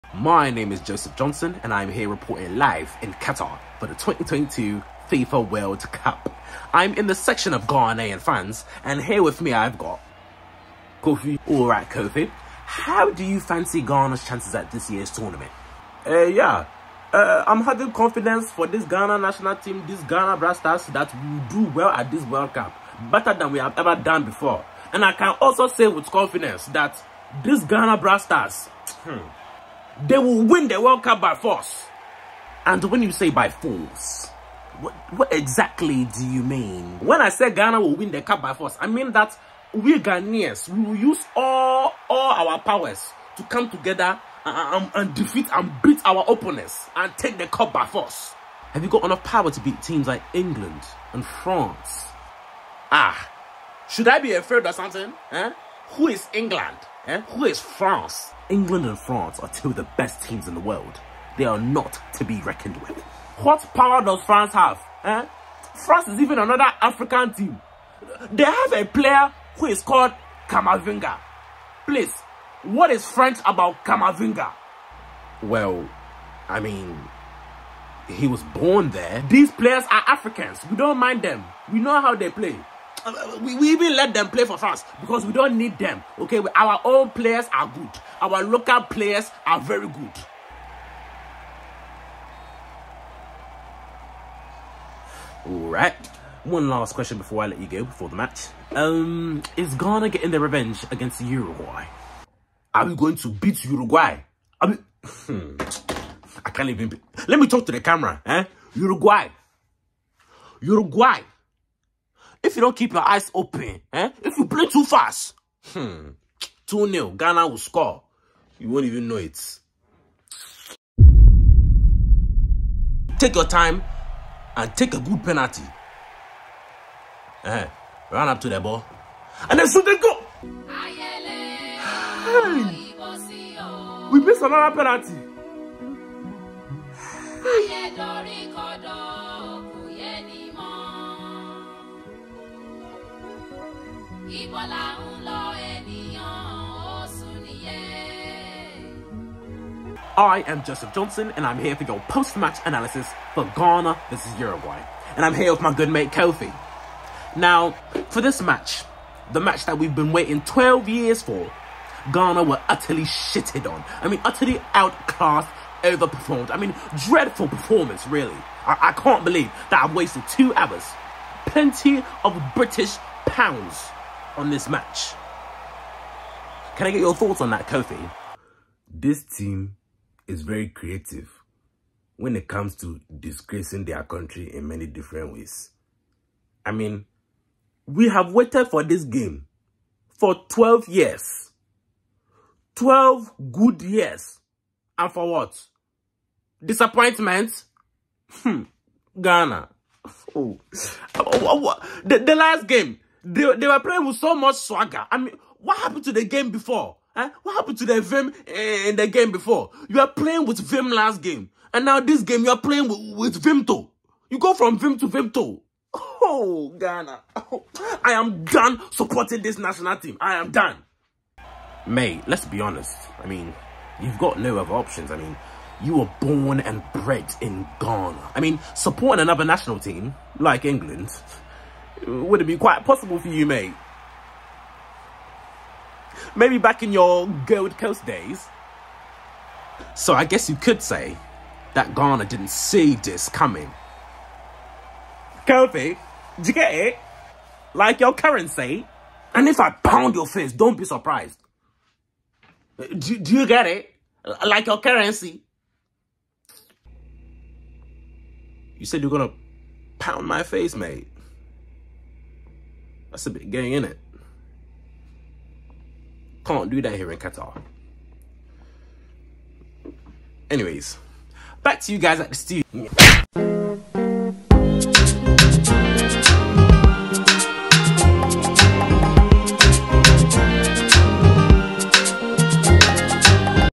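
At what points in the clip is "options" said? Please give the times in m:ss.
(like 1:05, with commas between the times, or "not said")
3:44.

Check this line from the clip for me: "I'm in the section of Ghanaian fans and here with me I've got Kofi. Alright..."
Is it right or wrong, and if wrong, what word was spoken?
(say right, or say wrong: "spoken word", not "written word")
right.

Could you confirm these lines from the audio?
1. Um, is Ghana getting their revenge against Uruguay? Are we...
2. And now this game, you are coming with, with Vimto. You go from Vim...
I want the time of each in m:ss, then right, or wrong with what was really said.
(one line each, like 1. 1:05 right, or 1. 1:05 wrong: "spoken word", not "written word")
1. 1:38 right
2. 3:31 wrong: "playing", not "coming".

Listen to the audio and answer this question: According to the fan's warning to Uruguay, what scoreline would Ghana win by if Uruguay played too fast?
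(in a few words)
2-0.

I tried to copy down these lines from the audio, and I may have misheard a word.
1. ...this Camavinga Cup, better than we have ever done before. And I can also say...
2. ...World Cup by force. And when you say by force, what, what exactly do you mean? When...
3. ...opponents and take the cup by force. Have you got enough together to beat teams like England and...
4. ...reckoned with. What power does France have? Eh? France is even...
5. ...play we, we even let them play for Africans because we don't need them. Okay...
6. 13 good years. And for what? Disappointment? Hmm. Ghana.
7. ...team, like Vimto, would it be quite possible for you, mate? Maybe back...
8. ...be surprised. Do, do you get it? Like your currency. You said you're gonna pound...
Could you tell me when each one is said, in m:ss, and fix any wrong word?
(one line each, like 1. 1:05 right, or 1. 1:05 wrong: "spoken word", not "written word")
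1. 0:22 wrong: "World", not "Camavinga"
2. 0:30 right
3. 0:46 wrong: "power", not "together"
4. 1:02 right
5. 1:22 wrong: "France", not "Africans"
6. 3:12 wrong: "12", not "13"
7. 3:49 wrong: "England", not "Vimto"
8. 4:10 right.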